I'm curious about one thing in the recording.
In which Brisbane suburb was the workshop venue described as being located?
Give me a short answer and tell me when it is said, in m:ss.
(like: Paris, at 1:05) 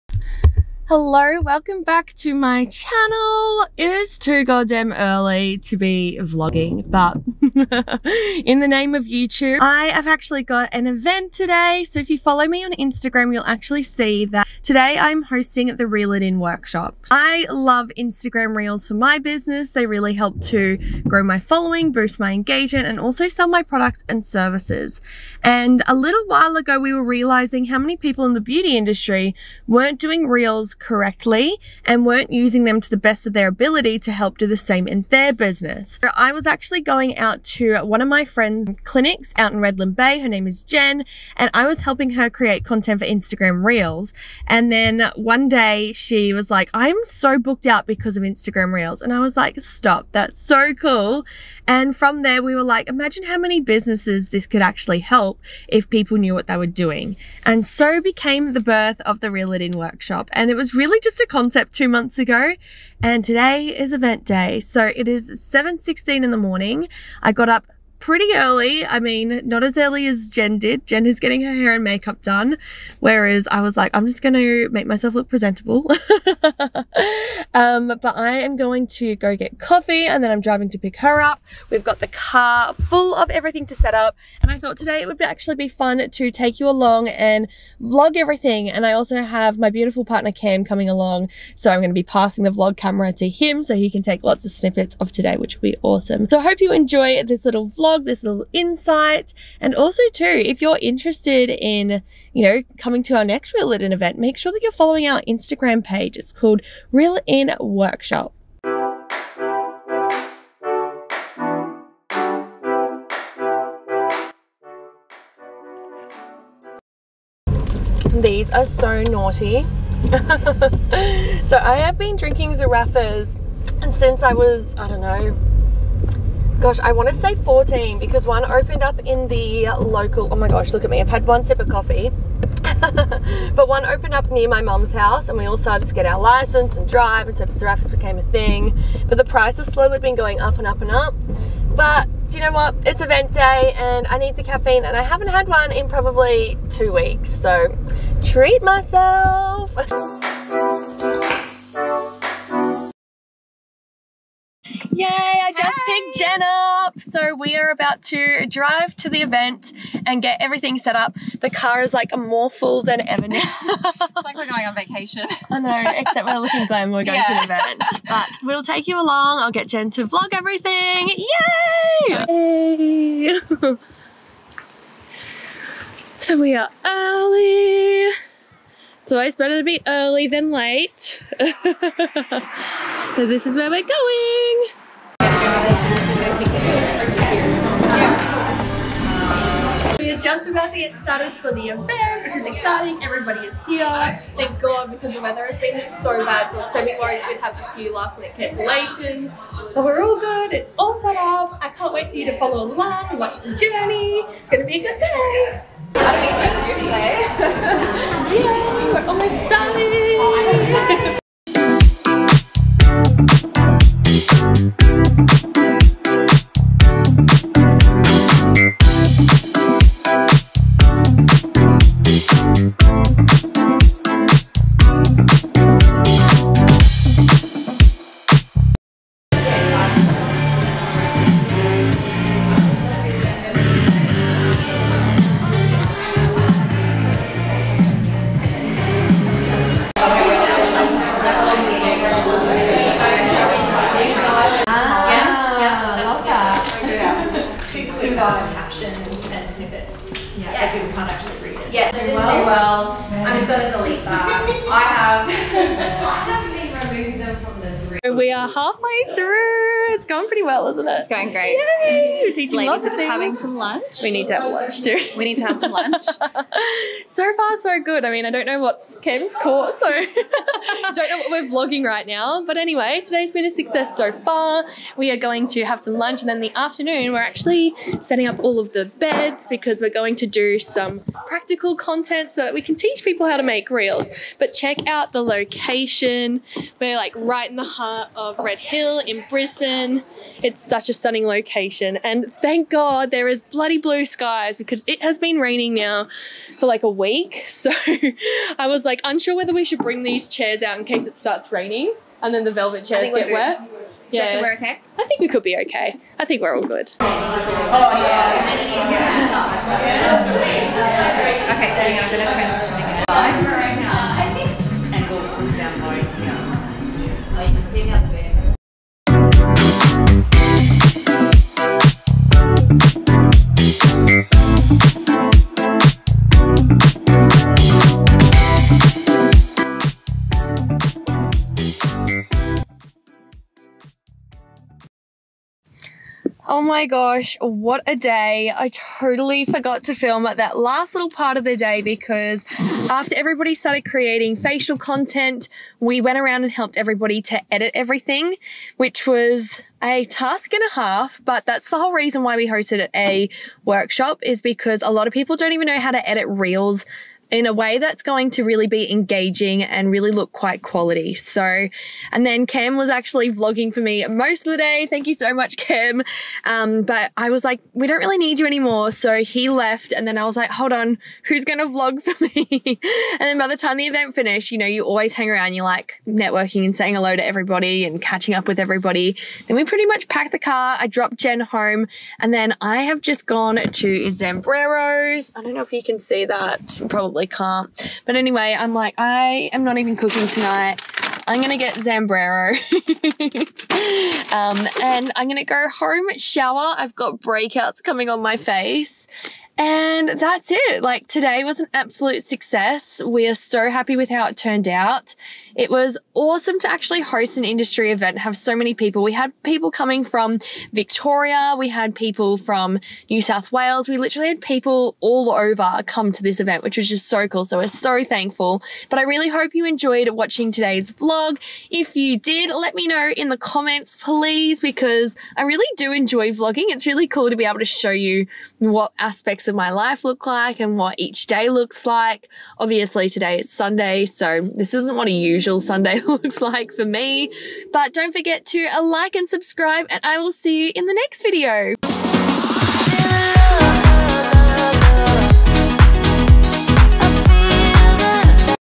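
Red Hill, at 4:48.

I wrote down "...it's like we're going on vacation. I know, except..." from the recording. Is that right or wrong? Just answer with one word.
right.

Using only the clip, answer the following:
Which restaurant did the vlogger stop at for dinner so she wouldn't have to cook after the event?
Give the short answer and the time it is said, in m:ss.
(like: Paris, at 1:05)
Zambrero, at 6:31.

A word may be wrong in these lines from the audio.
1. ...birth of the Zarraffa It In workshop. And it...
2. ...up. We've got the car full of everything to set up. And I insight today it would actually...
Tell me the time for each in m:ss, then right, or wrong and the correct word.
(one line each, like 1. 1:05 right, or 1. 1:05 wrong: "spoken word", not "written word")
1. 0:58 wrong: "Reel", not "Zarraffa"
2. 1:21 wrong: "thought", not "insight".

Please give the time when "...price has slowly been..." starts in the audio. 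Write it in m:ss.
2:19.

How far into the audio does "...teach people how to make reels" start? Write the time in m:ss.
4:42.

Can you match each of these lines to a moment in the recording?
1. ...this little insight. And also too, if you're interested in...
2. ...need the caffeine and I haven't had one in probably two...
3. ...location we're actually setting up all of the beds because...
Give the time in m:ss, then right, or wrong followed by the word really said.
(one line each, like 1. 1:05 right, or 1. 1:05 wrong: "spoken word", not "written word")
1. 1:38 right
2. 2:24 right
3. 4:36 wrong: "afternoon", not "location".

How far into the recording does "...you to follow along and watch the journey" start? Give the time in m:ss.
3:22.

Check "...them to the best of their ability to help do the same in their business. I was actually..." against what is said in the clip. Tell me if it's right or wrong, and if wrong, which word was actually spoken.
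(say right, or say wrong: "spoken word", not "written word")
right.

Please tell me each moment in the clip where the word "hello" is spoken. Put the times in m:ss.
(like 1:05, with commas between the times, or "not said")
0:00, 6:16.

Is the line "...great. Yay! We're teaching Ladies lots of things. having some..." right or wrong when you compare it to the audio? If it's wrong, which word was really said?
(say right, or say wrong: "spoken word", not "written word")
right.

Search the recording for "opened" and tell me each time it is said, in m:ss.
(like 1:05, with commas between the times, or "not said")
2:08, 2:13.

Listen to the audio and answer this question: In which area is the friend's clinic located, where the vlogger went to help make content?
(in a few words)
Redland Bay.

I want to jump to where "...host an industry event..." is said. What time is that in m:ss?
6:47.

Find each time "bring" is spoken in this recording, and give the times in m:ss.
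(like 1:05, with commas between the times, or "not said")
4:59.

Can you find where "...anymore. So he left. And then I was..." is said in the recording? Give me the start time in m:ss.
6:08.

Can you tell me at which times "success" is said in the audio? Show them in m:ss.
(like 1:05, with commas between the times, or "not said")
4:33, 6:42.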